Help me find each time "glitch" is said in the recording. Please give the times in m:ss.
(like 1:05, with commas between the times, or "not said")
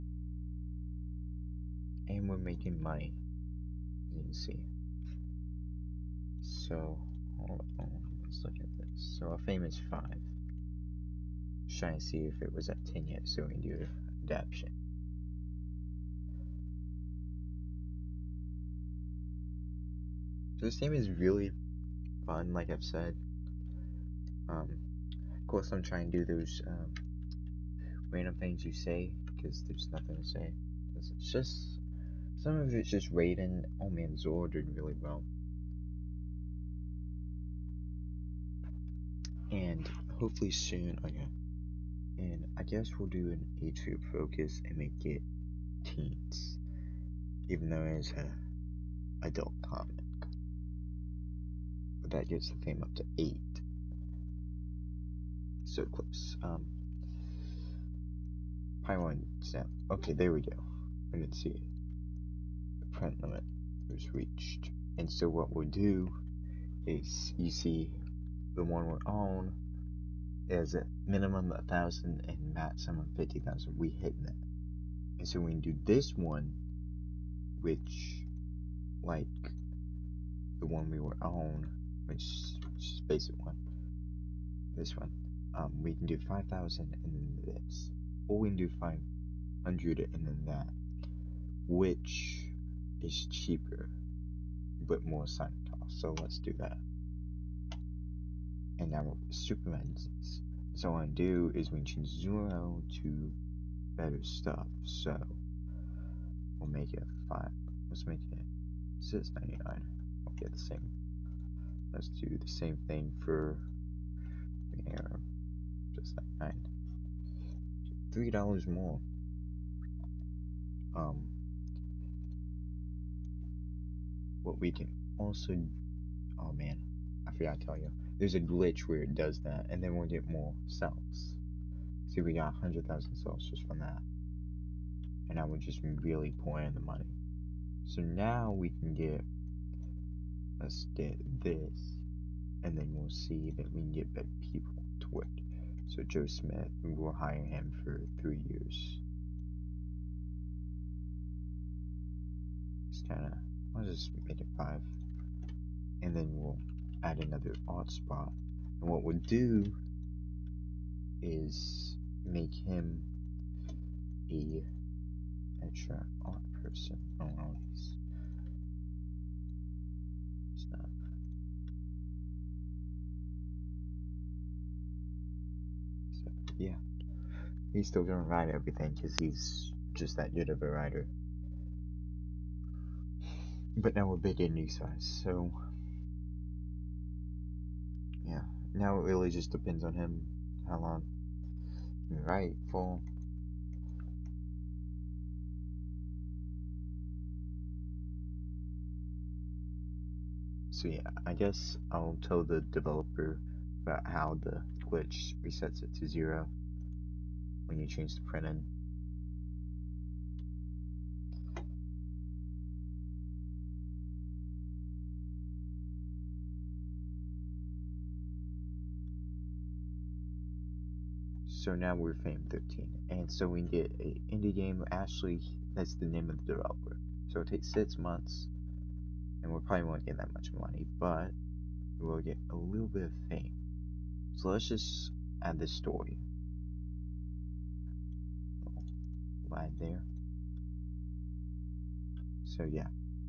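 2:08, 3:24.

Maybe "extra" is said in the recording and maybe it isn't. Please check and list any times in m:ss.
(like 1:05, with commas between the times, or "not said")
2:45.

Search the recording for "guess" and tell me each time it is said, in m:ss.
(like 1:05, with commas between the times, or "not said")
0:42, 3:21.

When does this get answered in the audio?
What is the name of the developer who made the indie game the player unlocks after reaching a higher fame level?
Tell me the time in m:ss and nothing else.
3:44.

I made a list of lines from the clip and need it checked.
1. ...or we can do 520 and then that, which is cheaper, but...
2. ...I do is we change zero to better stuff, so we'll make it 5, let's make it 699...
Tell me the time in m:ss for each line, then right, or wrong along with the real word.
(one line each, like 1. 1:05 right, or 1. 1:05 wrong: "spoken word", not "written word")
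1. 1:28 wrong: "500", not "520"
2. 1:41 right.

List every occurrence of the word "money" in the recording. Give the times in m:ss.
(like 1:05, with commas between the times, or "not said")
0:02, 2:16, 3:50.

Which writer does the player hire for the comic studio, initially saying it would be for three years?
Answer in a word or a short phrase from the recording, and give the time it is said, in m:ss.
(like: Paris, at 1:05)
Joe Smith, at 2:26.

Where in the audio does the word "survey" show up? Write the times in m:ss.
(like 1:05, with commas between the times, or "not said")
not said.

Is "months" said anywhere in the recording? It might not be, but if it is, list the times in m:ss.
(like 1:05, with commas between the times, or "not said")
3:47.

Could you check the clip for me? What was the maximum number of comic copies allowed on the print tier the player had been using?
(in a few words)
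50,000.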